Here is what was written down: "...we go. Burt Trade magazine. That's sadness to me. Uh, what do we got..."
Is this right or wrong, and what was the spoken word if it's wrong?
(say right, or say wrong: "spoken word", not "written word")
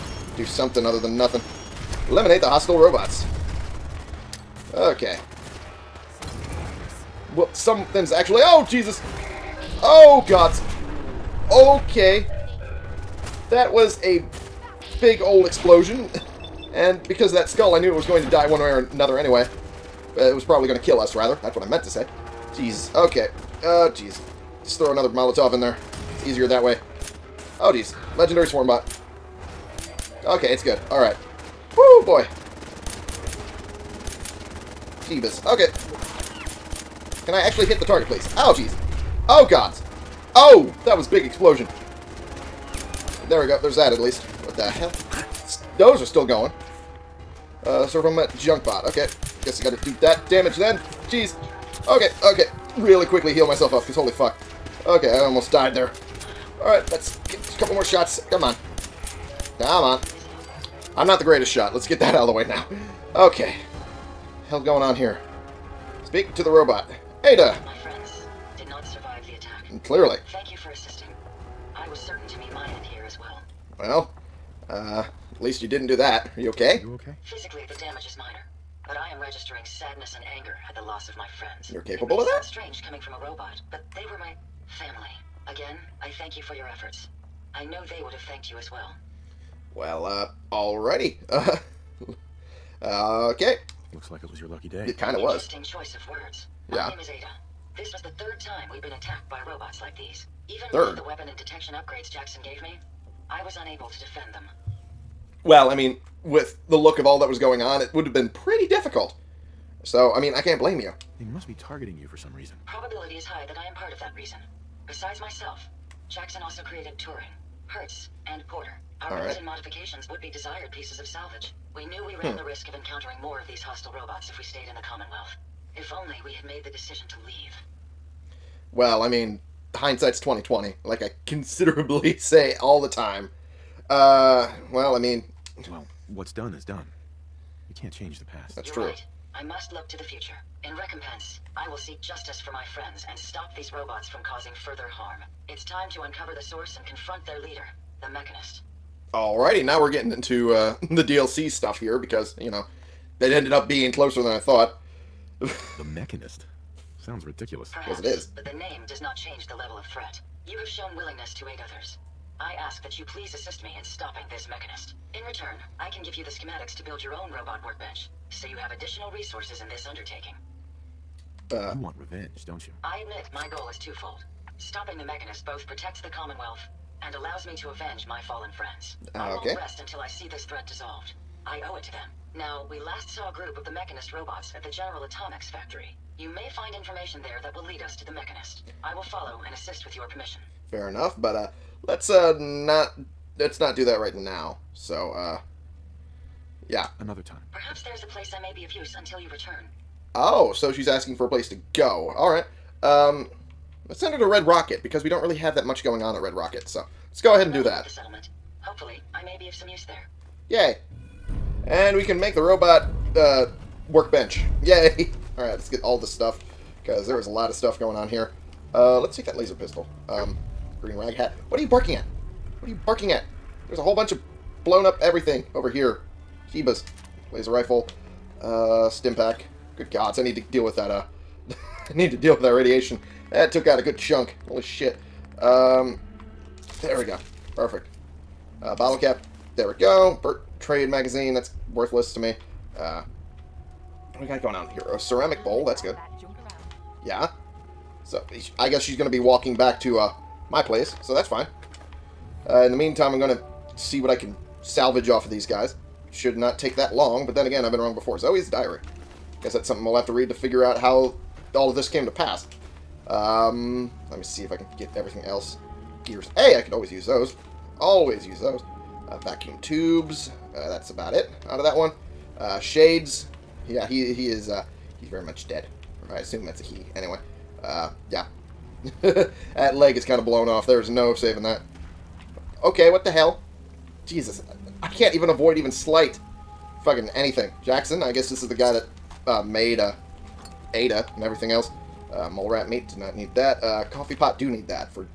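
wrong: "worthless", not "sadness".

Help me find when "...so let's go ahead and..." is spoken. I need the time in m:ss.
3:26.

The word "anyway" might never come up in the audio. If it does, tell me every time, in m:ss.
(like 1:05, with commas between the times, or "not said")
0:19, 4:36.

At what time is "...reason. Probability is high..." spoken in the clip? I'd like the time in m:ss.
1:52.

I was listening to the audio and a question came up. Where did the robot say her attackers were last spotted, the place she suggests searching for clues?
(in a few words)
General Atomics factory.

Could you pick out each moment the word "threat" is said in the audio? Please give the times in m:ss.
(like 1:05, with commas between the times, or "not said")
2:39, 3:00.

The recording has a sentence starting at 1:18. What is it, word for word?
But I am registering sadness and anger at the loss of my friends.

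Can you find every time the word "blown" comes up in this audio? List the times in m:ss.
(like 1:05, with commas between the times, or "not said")
3:44, 4:40.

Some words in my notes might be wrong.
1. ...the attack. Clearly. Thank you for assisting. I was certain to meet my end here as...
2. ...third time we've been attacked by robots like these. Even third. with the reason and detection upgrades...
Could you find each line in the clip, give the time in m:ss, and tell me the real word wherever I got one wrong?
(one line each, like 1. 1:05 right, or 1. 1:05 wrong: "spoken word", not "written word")
1. 1:09 right
2. 1:38 wrong: "weapon", not "reason".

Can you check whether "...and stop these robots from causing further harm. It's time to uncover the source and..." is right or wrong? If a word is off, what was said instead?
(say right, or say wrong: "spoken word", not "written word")
right.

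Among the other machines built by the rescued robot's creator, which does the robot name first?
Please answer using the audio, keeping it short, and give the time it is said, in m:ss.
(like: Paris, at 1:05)
Turing, at 1:56.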